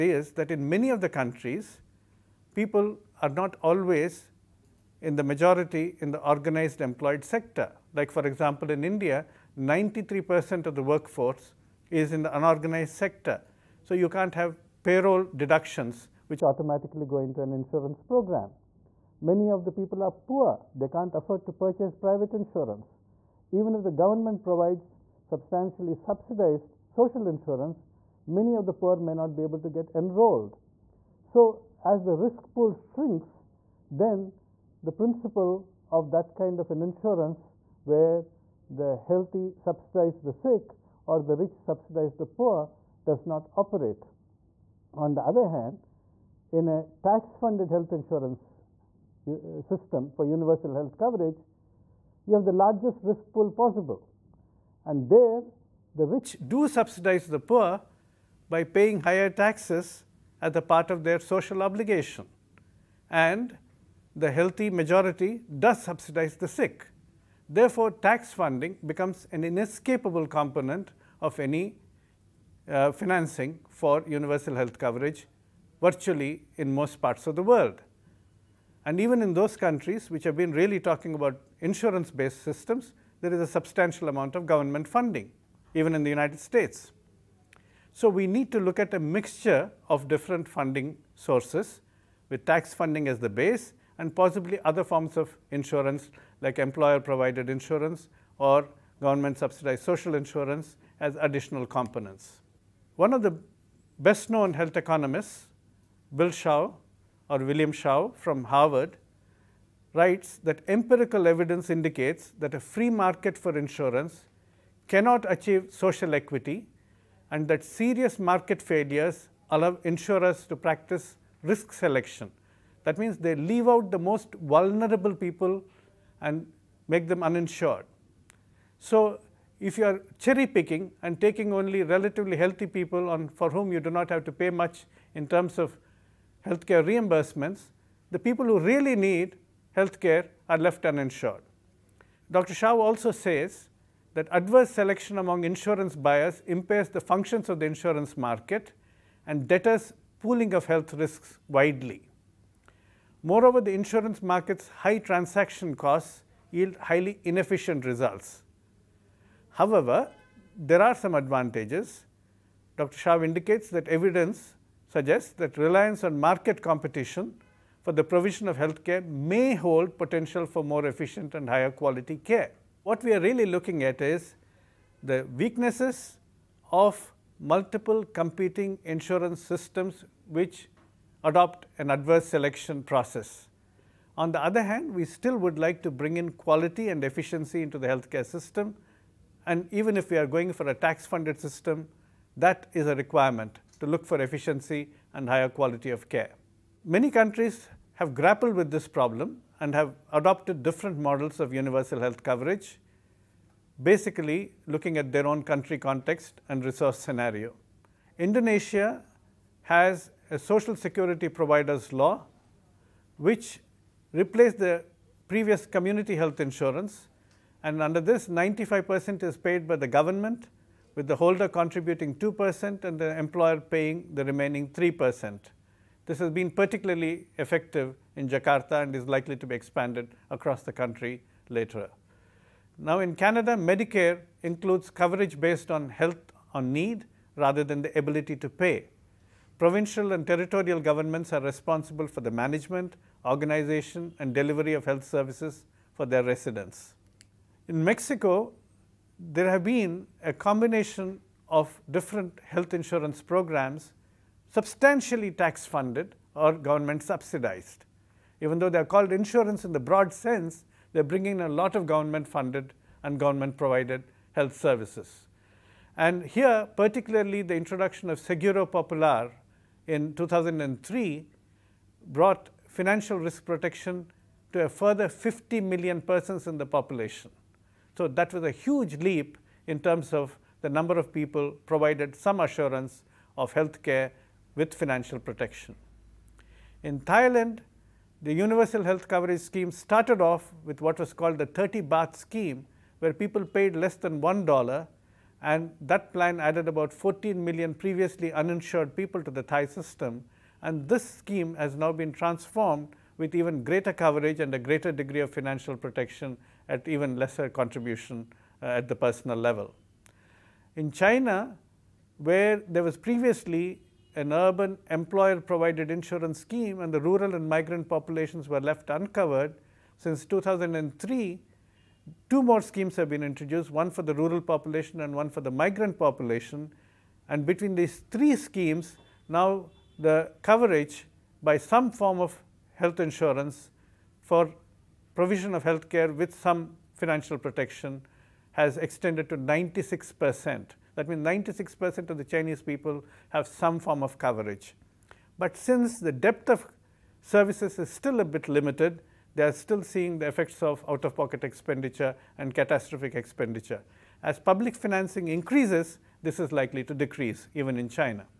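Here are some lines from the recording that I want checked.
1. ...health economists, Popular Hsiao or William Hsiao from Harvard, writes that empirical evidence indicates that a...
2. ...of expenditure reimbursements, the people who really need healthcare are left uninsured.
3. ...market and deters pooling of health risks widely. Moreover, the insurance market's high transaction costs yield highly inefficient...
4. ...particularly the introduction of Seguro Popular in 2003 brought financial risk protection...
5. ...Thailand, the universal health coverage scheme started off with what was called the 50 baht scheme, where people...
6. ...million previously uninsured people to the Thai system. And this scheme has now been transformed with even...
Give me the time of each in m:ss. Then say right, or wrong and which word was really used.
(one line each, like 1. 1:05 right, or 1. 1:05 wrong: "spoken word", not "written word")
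1. 1:44 wrong: "Bill", not "Popular"
2. 2:15 wrong: "healthcare", not "expenditure"
3. 2:28 right
4. 4:26 right
5. 4:47 wrong: "30", not "50"
6. 4:57 right.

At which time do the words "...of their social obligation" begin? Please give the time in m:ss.
1:00.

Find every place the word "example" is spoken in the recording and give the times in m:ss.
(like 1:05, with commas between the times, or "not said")
0:08.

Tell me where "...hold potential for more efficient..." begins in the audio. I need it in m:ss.
2:49.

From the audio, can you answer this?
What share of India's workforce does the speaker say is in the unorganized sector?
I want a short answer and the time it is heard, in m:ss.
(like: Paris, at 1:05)
93 percent, at 0:09.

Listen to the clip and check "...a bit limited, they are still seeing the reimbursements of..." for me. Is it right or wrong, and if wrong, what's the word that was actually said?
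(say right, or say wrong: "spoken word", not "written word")
wrong: "effects", not "reimbursements".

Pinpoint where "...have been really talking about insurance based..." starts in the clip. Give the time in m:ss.
1:20.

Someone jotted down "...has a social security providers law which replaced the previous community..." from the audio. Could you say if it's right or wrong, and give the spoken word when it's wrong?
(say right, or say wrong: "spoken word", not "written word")
right.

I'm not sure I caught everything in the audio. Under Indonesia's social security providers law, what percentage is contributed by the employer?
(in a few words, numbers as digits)
3 percent.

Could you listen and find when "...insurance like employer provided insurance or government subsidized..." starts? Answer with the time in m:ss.
1:35.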